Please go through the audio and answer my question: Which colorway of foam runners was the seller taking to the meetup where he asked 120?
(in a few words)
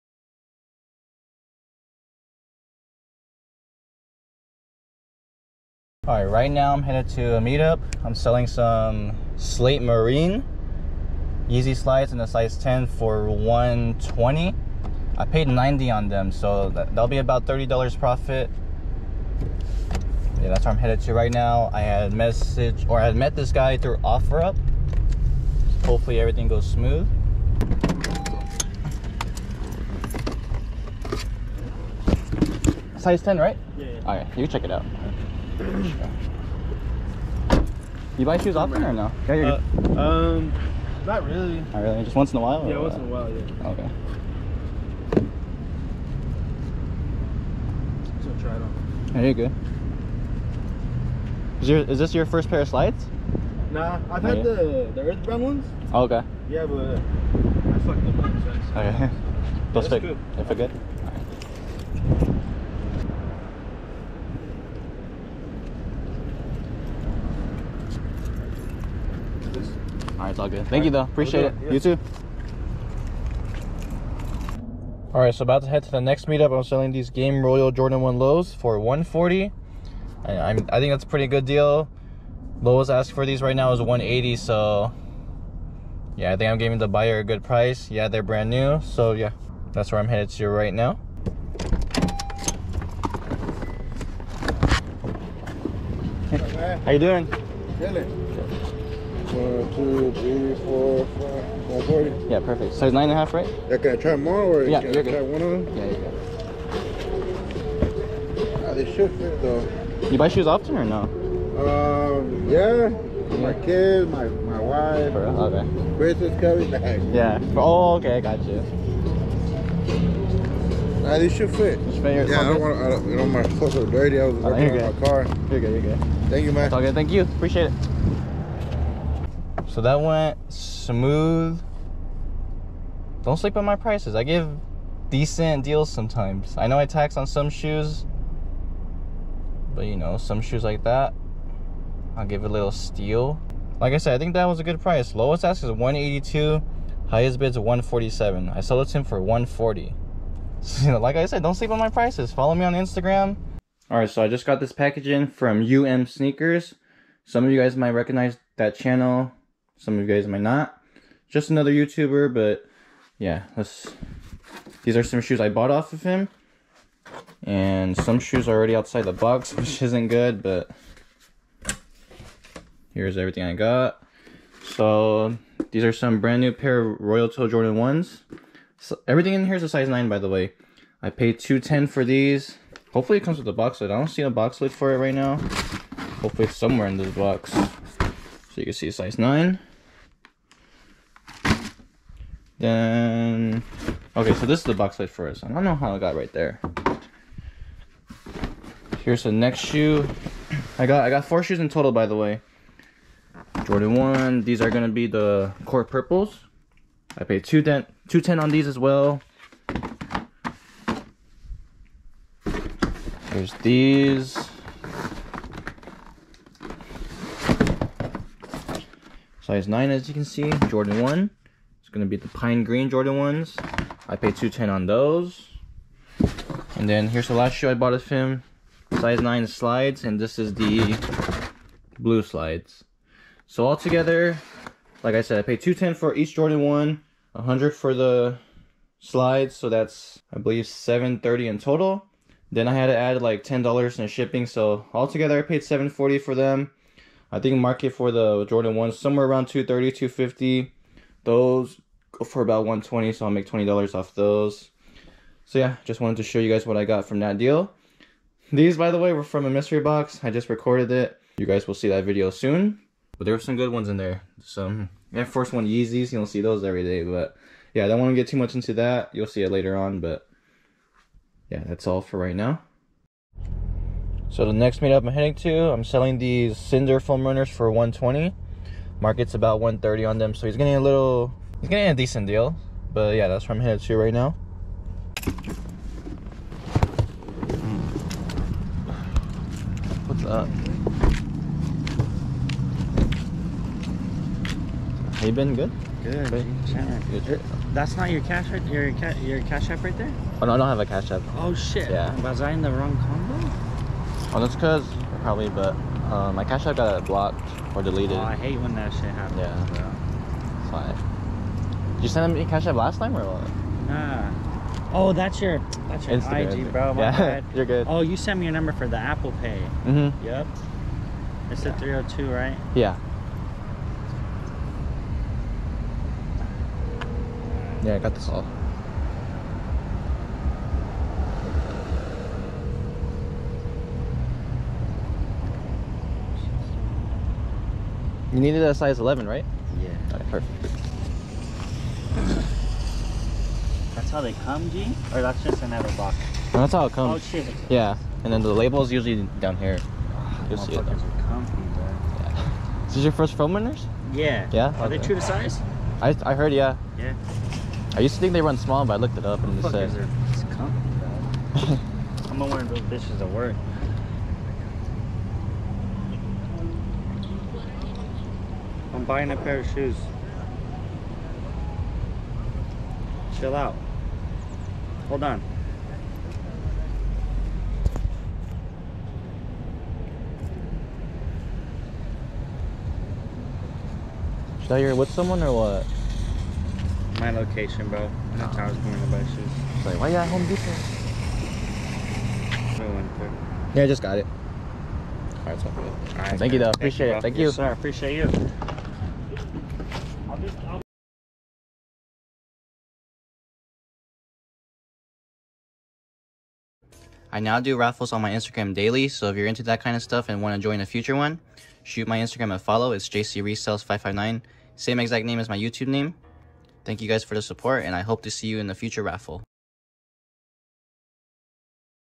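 Cinder.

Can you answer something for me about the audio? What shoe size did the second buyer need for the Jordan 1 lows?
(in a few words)
9.5.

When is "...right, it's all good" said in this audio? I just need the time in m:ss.
1:10.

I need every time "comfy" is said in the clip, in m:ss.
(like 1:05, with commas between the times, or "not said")
5:51, 6:00.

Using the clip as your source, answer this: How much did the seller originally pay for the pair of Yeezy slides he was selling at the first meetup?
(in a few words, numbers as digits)
$90.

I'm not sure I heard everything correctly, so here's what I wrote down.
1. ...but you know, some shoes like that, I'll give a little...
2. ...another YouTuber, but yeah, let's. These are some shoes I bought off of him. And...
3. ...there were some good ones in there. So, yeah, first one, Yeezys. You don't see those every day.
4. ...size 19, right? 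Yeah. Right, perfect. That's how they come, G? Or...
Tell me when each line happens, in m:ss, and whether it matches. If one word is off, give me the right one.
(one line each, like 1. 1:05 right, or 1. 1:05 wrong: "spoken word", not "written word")
1. 2:19 right
2. 2:41 right
3. 4:23 right
4. 5:38 wrong: "11", not "19".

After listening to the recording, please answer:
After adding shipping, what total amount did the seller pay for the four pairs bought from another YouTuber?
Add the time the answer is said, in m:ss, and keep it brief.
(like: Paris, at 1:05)
$740, at 4:05.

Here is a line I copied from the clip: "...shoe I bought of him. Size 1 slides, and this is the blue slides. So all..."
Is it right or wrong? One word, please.
wrong.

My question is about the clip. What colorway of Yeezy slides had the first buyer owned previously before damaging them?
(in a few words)
Earth brown.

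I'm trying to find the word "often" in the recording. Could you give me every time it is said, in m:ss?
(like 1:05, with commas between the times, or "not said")
0:38, 1:50.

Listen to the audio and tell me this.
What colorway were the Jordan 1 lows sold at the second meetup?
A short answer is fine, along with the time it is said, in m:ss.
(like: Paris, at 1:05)
Game Royal, at 1:17.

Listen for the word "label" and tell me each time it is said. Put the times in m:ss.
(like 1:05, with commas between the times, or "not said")
5:48.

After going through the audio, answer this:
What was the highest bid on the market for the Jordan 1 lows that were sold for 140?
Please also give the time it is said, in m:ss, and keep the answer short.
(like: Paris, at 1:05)
$147, at 2:27.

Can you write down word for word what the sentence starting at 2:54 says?
So these are some brand new pair of Royal Toe Jordan 1s.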